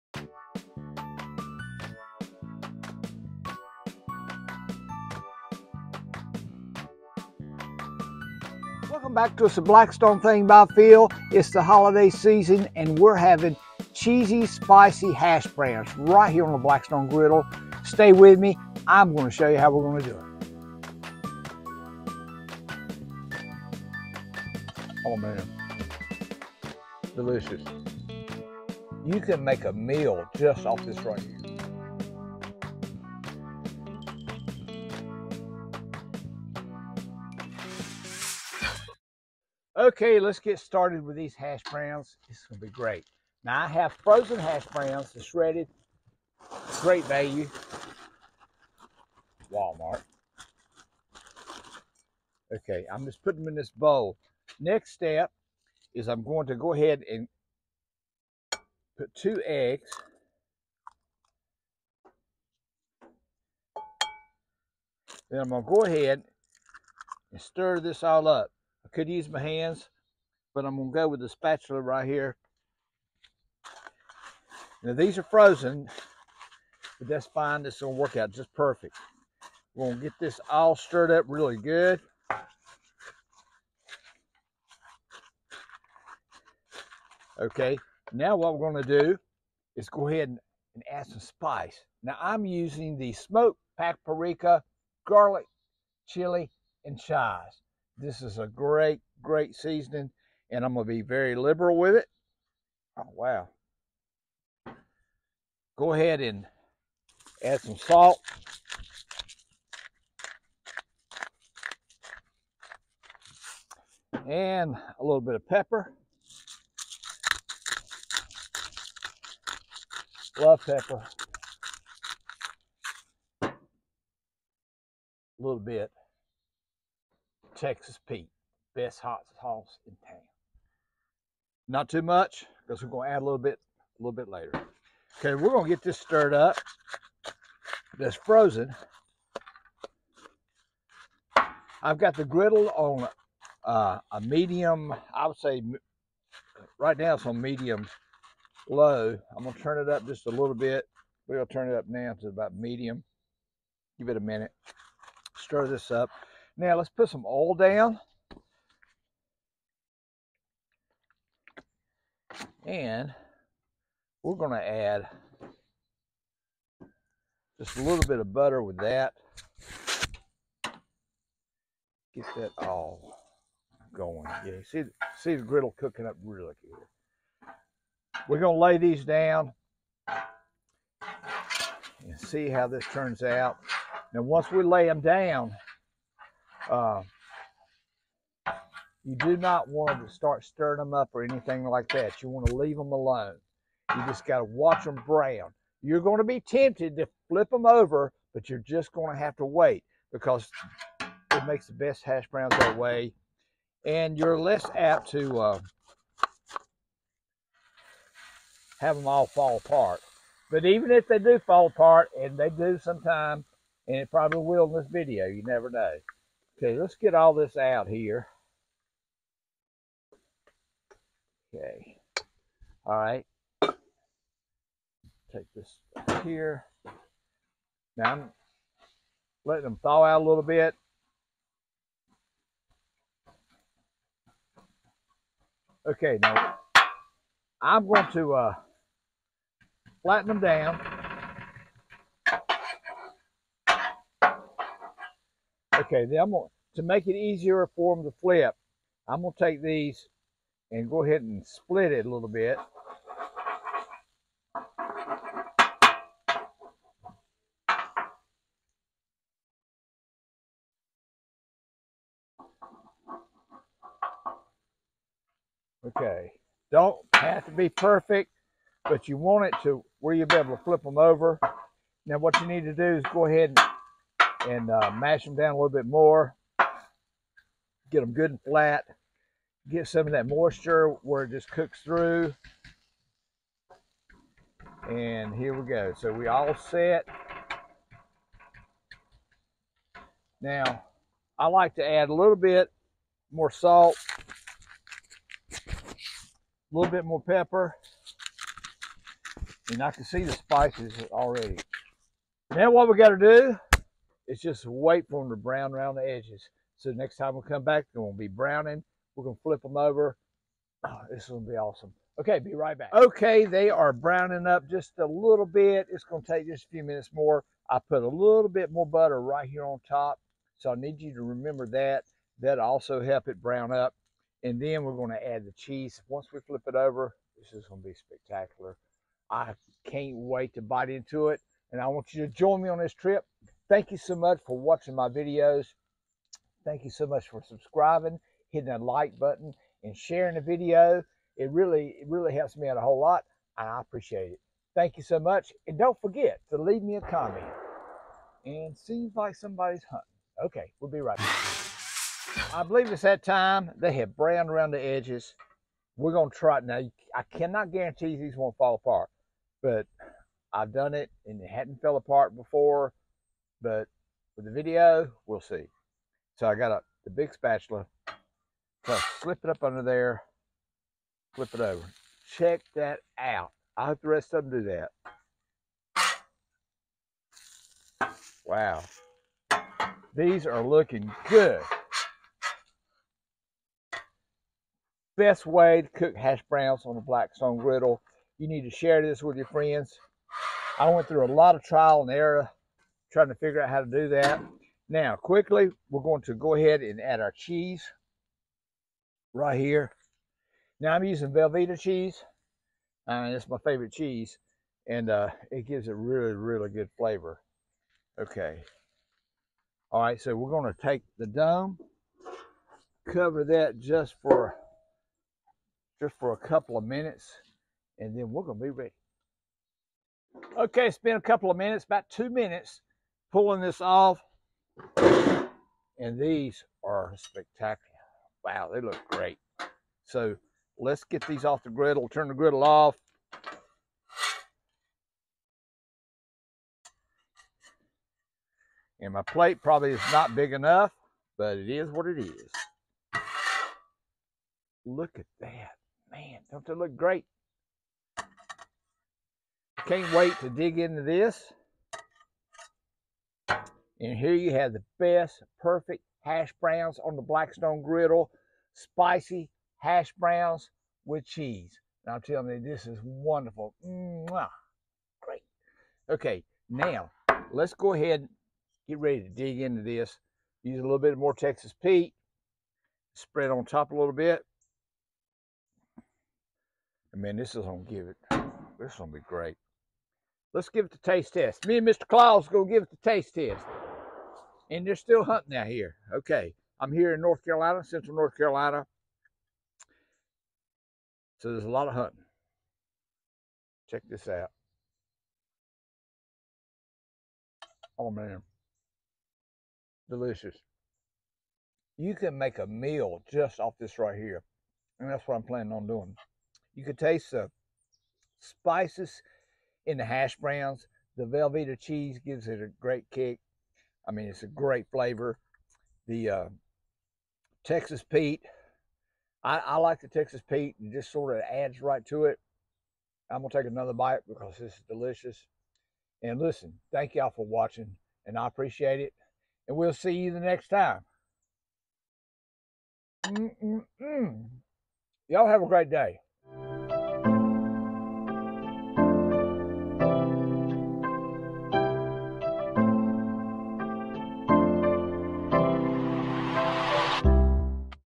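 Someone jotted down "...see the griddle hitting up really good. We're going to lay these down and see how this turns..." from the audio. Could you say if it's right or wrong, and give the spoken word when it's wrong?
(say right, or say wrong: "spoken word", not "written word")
wrong: "cooking", not "hitting".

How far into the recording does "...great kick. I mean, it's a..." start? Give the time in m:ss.
8:32.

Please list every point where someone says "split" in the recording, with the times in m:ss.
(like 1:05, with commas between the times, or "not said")
4:11.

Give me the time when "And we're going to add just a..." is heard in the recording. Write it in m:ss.
2:42.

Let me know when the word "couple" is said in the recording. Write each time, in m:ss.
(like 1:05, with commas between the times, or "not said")
6:56, 7:01.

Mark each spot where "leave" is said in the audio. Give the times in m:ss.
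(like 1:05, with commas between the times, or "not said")
3:12, 5:46.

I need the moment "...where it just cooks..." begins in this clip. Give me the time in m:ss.
4:41.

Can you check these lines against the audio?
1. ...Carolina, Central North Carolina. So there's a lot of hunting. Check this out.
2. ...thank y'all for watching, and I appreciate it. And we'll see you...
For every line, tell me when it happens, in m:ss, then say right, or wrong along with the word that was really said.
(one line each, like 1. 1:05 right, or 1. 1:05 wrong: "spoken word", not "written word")
1. 8:07 right
2. 8:46 right.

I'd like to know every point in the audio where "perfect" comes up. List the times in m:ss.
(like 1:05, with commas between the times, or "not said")
1:18, 4:27, 7:35.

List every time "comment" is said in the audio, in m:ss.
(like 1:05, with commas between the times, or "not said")
5:47.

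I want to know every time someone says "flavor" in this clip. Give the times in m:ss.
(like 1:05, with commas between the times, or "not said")
6:46, 8:34.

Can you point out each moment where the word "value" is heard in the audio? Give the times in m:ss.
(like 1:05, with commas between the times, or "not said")
0:47.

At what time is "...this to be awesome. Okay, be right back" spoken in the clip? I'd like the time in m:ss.
5:11.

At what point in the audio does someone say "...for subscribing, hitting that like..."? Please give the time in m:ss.
5:37.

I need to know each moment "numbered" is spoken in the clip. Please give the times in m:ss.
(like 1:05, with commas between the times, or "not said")
not said.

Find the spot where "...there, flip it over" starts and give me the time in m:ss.
6:09.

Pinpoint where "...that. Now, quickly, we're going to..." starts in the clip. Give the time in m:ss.
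6:34.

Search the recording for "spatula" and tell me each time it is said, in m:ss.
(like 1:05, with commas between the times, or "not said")
1:11, 6:07.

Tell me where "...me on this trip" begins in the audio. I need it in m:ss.
5:32.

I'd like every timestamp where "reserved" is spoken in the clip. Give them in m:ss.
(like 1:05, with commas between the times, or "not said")
not said.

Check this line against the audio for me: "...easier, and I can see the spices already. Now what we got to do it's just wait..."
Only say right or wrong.
wrong.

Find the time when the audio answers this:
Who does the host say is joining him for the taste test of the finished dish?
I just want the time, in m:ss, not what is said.
8:01.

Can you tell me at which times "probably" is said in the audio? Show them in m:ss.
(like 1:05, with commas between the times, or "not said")
3:34, 7:19.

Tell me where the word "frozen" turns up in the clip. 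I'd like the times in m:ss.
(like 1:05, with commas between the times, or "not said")
0:44, 1:15, 2:18.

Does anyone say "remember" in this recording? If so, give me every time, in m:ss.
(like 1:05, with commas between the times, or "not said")
5:21.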